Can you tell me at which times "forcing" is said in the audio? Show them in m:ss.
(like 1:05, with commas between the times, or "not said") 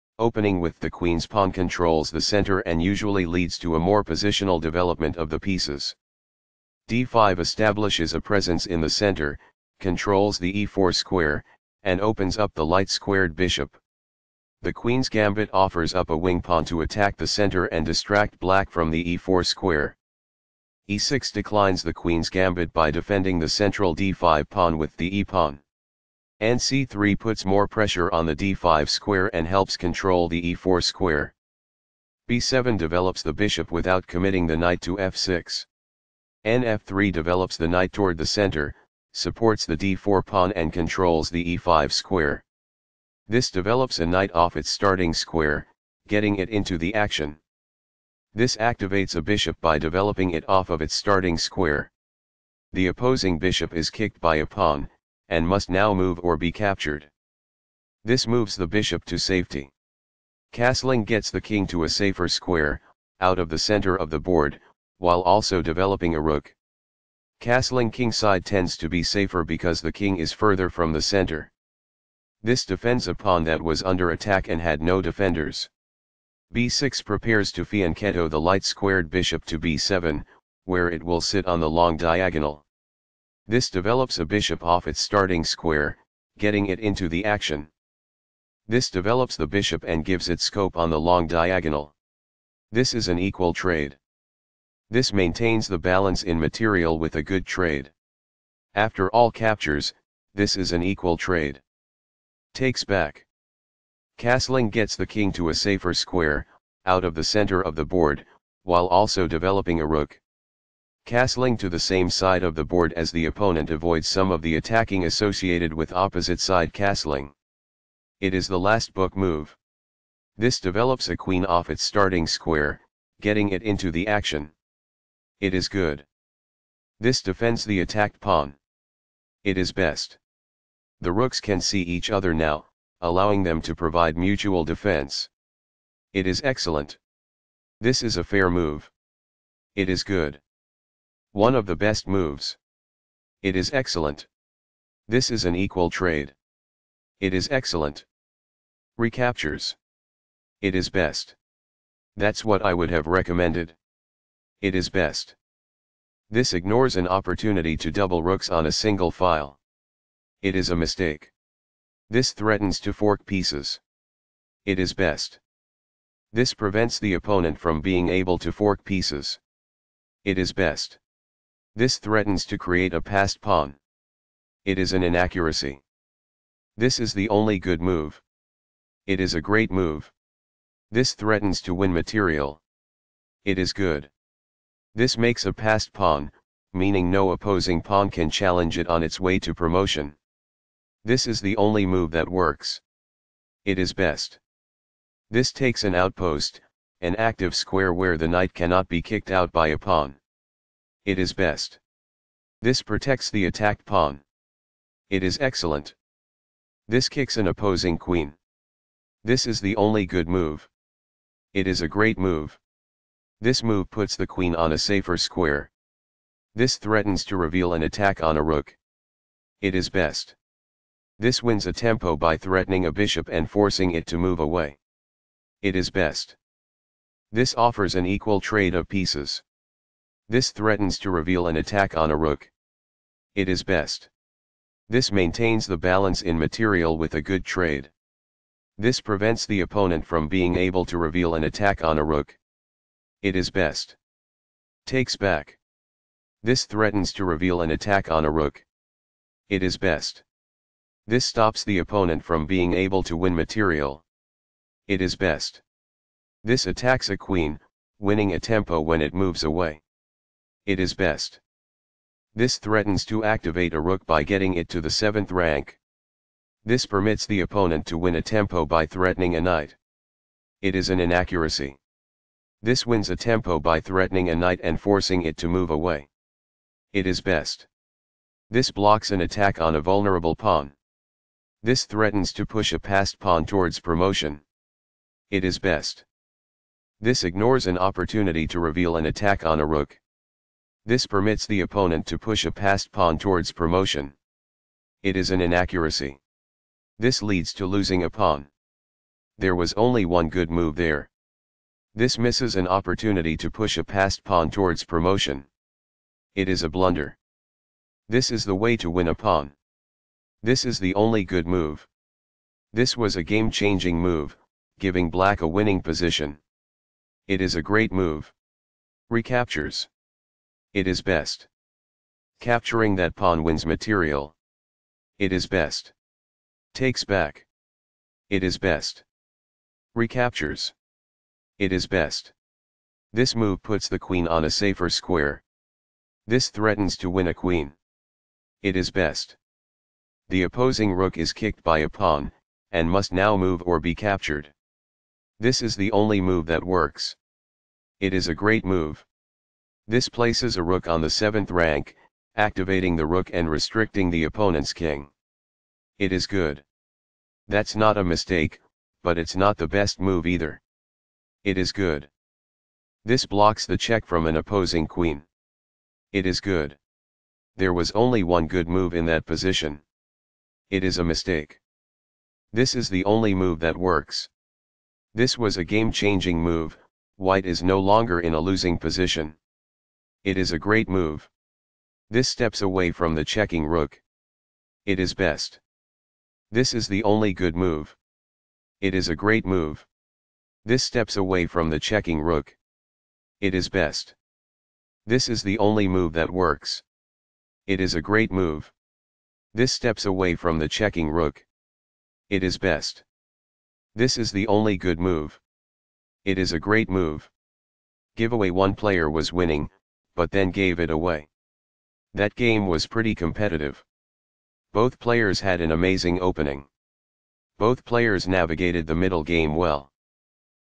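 3:43, 4:34.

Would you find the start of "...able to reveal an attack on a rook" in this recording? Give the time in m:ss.
4:00.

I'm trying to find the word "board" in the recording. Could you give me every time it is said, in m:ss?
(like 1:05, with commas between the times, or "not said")
1:04, 1:47, 1:52.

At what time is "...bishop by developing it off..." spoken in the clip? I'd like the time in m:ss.
0:49.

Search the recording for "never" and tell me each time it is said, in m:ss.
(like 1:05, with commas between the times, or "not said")
not said.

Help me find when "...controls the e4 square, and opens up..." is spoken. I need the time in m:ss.
0:09.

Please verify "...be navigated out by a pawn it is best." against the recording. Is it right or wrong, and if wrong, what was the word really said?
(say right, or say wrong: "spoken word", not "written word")
wrong: "kicked", not "navigated".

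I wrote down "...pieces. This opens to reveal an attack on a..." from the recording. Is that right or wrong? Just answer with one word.
wrong.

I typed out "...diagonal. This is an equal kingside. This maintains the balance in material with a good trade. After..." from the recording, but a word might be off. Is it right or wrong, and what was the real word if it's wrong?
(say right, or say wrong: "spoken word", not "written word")
wrong: "trade", not "kingside".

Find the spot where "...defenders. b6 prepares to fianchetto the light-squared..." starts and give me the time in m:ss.
1:15.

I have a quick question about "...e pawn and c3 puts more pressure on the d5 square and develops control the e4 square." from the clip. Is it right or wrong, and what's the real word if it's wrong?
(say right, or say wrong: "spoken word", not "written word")
wrong: "helps", not "develops".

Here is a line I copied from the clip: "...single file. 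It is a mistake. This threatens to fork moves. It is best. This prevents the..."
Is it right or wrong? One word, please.
wrong.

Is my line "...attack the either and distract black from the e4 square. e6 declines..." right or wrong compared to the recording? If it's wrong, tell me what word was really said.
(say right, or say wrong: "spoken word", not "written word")
wrong: "center", not "either".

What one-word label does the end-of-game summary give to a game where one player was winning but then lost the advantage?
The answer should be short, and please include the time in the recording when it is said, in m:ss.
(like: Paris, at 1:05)
Giveaway, at 6:48.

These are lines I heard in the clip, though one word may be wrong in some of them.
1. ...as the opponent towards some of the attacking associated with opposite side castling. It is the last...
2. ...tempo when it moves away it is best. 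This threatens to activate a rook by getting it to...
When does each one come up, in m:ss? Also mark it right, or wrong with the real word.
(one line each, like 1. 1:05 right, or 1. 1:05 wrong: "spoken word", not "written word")
1. 1:52 wrong: "avoids", not "towards"
2. 4:18 right.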